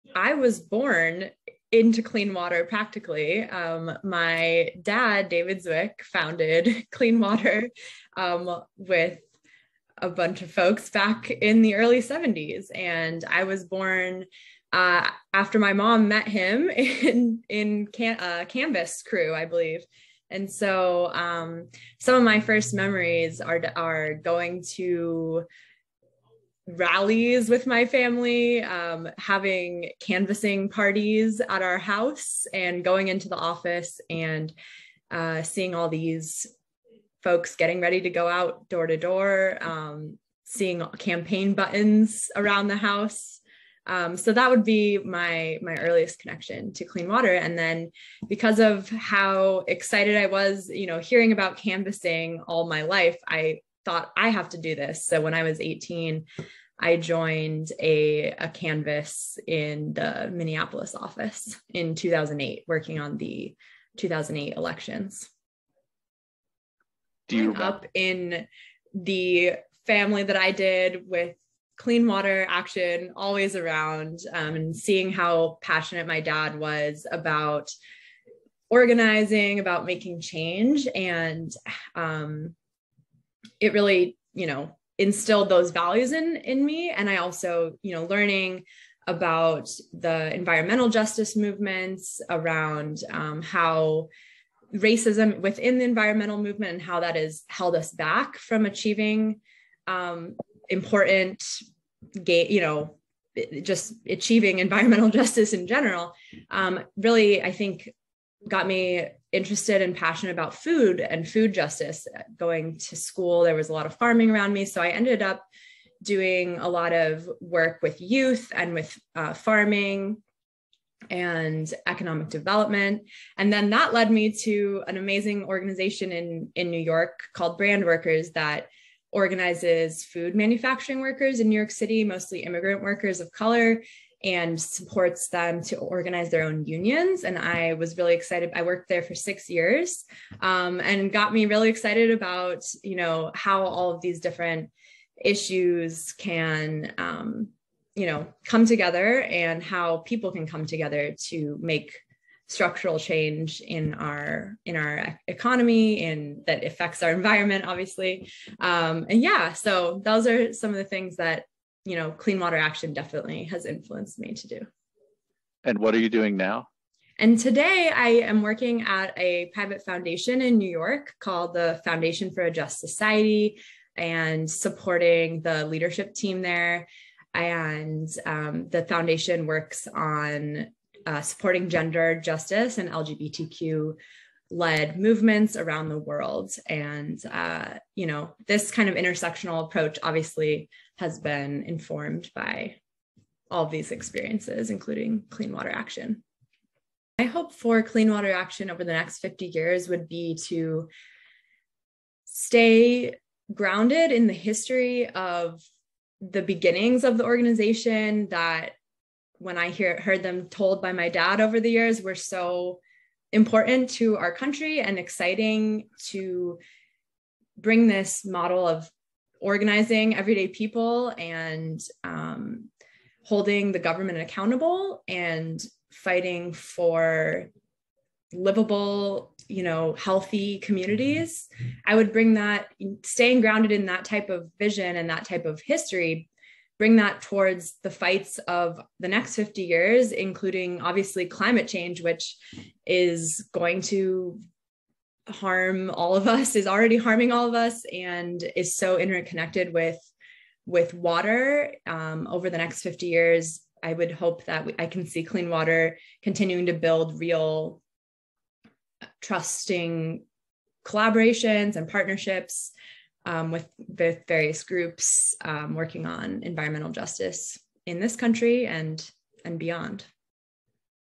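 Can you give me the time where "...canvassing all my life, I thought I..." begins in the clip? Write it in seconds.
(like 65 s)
51 s.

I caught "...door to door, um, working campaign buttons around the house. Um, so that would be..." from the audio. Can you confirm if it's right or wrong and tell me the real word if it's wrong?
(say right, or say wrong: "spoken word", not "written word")
wrong: "seeing", not "working".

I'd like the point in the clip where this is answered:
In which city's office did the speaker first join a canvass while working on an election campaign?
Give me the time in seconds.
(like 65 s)
60 s.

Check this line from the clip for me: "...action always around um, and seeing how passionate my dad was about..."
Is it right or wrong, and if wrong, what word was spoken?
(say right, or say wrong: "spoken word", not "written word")
right.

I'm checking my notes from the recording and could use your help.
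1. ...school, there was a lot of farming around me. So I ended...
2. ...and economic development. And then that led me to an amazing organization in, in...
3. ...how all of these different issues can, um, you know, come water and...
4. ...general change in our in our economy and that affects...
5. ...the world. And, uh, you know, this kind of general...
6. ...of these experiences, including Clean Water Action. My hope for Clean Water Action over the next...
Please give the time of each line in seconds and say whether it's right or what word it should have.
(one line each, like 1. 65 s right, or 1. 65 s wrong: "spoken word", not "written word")
1. 112 s right
2. 121 s right
3. 143 s wrong: "together", not "water"
4. 152 s wrong: "structural", not "general"
5. 185 s wrong: "intersectional", not "general"
6. 193 s right.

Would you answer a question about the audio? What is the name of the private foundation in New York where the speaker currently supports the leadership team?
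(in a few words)
Foundation for a Just Society.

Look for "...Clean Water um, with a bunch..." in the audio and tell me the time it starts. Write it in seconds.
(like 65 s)
6 s.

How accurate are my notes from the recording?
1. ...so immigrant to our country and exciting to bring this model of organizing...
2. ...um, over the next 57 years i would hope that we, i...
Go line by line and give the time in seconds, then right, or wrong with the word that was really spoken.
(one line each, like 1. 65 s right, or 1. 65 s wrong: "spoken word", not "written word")
1. 212 s wrong: "important", not "immigrant"
2. 251 s wrong: "50", not "57".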